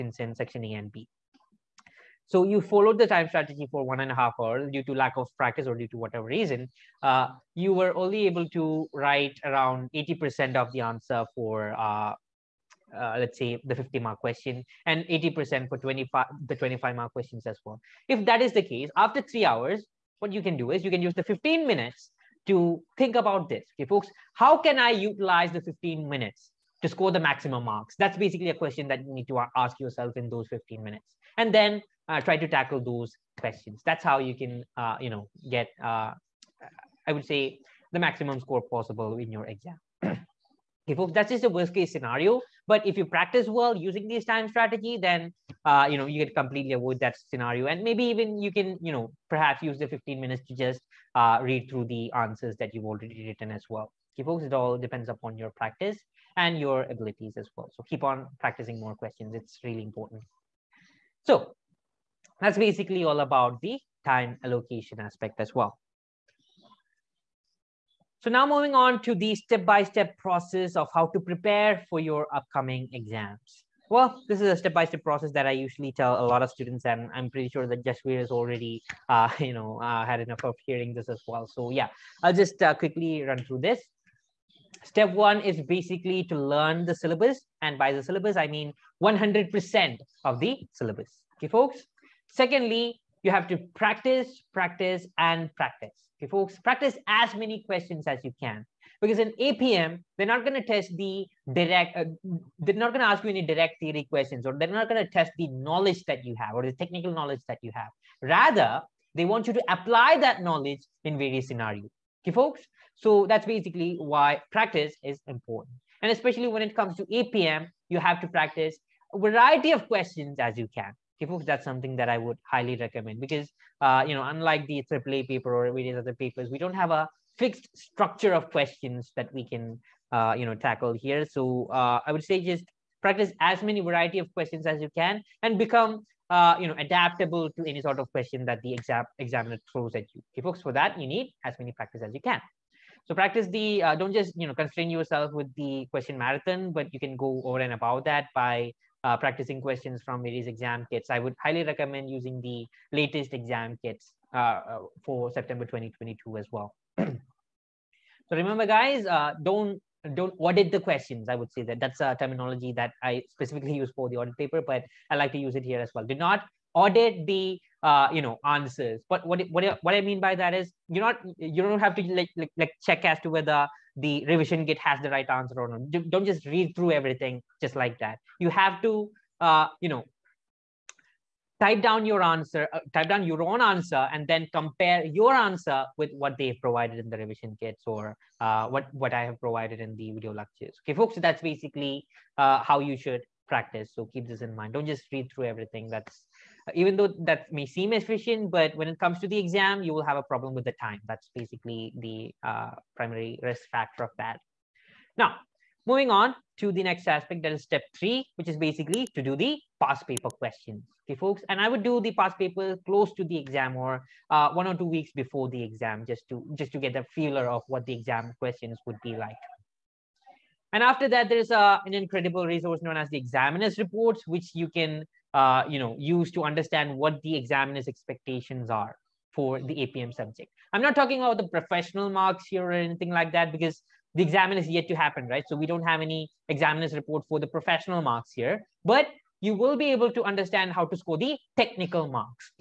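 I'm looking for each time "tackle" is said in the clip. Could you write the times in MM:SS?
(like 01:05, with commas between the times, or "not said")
00:32, 02:10.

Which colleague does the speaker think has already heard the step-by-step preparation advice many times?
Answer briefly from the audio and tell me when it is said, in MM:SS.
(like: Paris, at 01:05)
Jashveer, at 01:17.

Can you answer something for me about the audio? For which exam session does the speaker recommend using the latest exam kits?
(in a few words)
September 2022.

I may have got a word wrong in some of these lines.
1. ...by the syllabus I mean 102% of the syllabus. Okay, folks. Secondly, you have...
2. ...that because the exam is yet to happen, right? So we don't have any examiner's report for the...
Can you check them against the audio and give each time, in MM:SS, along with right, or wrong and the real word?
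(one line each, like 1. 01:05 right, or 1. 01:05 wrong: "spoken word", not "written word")
1. 01:27 wrong: "100", not "102"
2. 03:53 right.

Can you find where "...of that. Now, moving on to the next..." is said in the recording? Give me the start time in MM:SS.
03:24.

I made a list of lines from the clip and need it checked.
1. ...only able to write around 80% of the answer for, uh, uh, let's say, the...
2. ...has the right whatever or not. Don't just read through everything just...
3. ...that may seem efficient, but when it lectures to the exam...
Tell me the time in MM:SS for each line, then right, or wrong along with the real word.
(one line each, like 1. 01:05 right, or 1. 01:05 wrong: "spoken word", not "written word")
1. 00:07 right
2. 02:54 wrong: "answer", not "whatever"
3. 03:17 wrong: "comes", not "lectures".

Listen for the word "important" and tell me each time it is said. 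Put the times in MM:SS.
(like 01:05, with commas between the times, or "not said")
00:59, 01:55.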